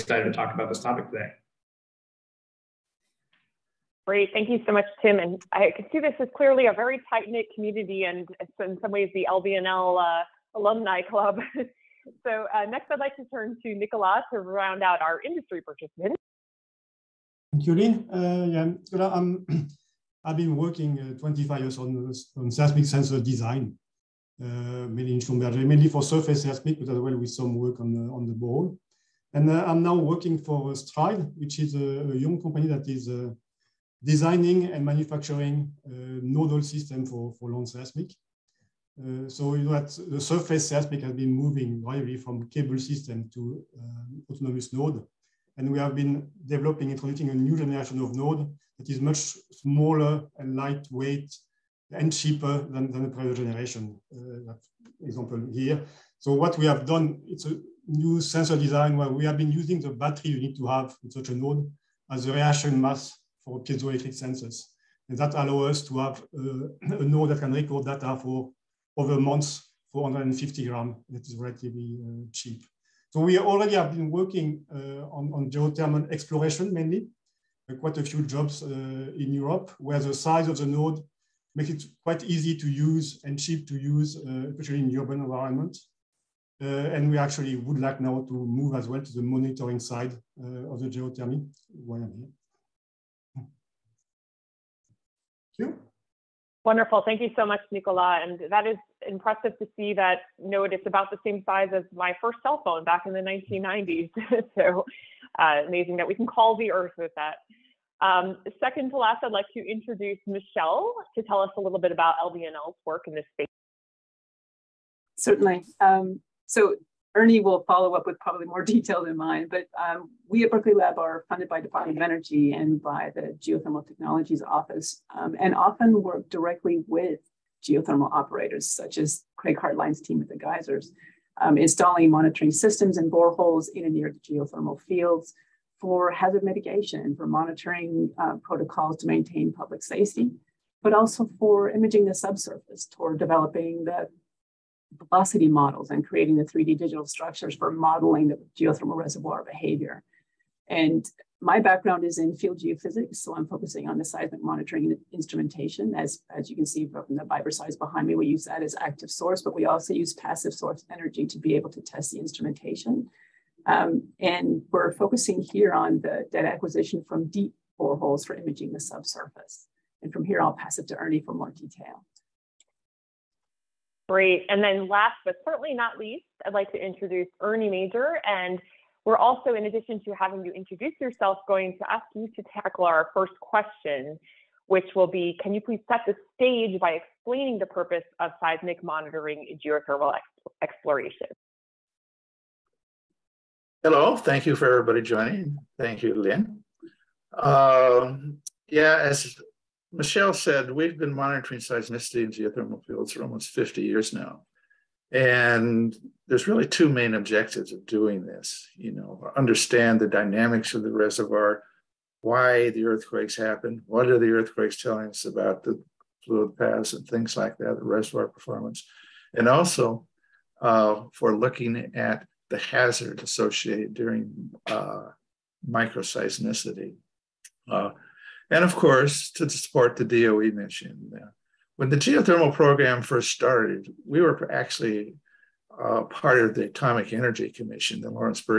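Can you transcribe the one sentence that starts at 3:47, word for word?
Uh, and of course to support the DOE mission.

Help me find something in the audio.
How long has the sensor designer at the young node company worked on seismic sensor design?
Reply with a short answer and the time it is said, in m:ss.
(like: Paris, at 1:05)
25 years, at 0:21.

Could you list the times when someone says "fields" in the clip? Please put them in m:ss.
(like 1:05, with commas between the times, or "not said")
2:14, 2:32, 3:22.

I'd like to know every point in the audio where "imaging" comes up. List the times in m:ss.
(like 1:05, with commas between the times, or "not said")
2:21, 2:48.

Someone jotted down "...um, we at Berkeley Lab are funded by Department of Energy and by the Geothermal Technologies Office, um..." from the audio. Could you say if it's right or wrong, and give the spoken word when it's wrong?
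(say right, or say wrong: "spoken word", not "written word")
right.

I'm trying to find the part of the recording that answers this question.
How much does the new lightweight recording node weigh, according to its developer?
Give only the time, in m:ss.
1:10.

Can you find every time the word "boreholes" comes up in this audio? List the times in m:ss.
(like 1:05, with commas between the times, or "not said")
0:28, 2:13, 2:47.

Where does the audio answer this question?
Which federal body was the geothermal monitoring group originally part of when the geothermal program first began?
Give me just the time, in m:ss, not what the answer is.
3:56.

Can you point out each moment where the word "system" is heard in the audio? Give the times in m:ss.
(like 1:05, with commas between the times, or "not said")
0:36, 0:42, 2:12.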